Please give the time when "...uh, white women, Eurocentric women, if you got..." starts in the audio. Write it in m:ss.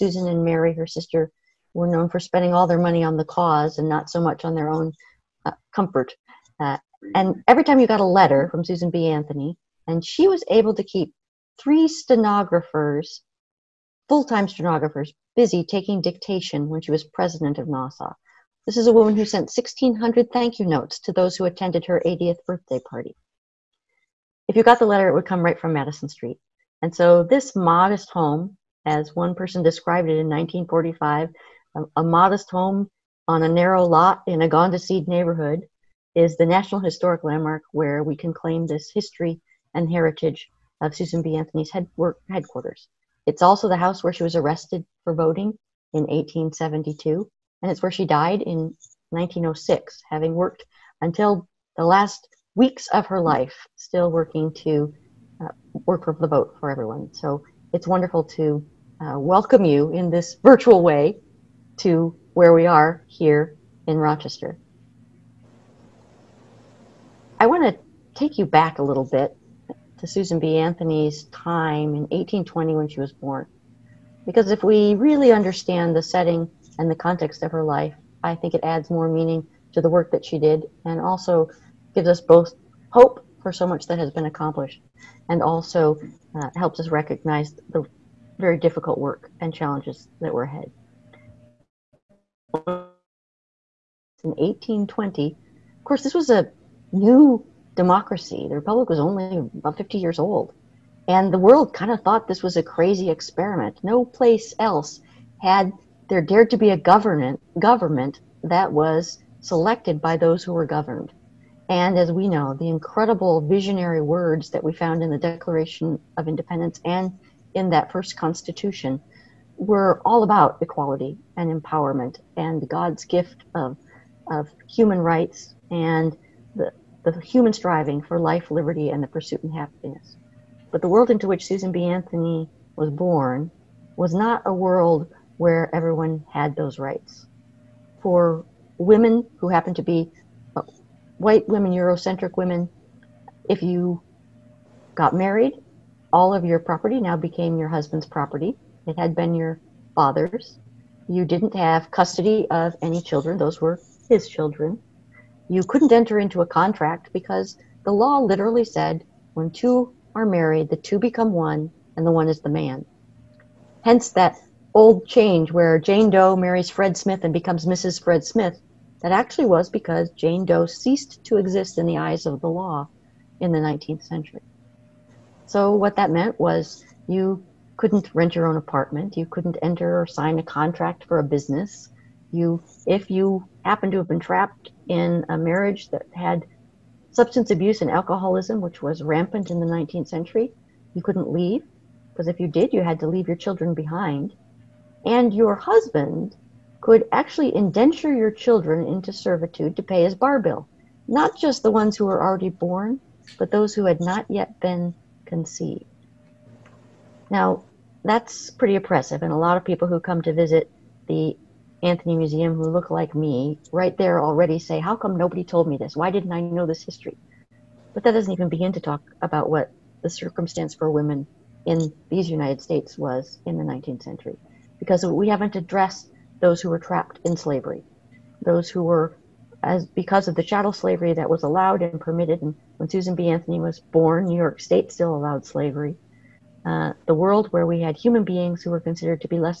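2:20.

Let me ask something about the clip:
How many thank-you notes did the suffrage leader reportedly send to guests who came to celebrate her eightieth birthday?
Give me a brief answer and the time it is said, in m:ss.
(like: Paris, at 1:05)
1,600, at 0:19.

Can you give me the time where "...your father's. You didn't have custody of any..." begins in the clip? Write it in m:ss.
2:29.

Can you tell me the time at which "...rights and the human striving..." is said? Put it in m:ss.
2:04.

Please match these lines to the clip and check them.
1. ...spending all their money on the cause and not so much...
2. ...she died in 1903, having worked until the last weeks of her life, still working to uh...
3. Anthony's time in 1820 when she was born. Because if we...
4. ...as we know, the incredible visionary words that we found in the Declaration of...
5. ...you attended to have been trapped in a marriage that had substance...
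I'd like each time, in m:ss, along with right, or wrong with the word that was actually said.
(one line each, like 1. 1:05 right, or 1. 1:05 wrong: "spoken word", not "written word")
1. 0:02 right
2. 0:47 wrong: "1906", not "1903"
3. 1:10 right
4. 1:51 right
5. 3:03 wrong: "happened", not "attended".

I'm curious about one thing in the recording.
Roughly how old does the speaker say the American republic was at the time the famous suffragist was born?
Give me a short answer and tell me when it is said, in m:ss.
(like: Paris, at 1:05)
about 50 years, at 1:39.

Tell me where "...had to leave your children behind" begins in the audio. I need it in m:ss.
3:12.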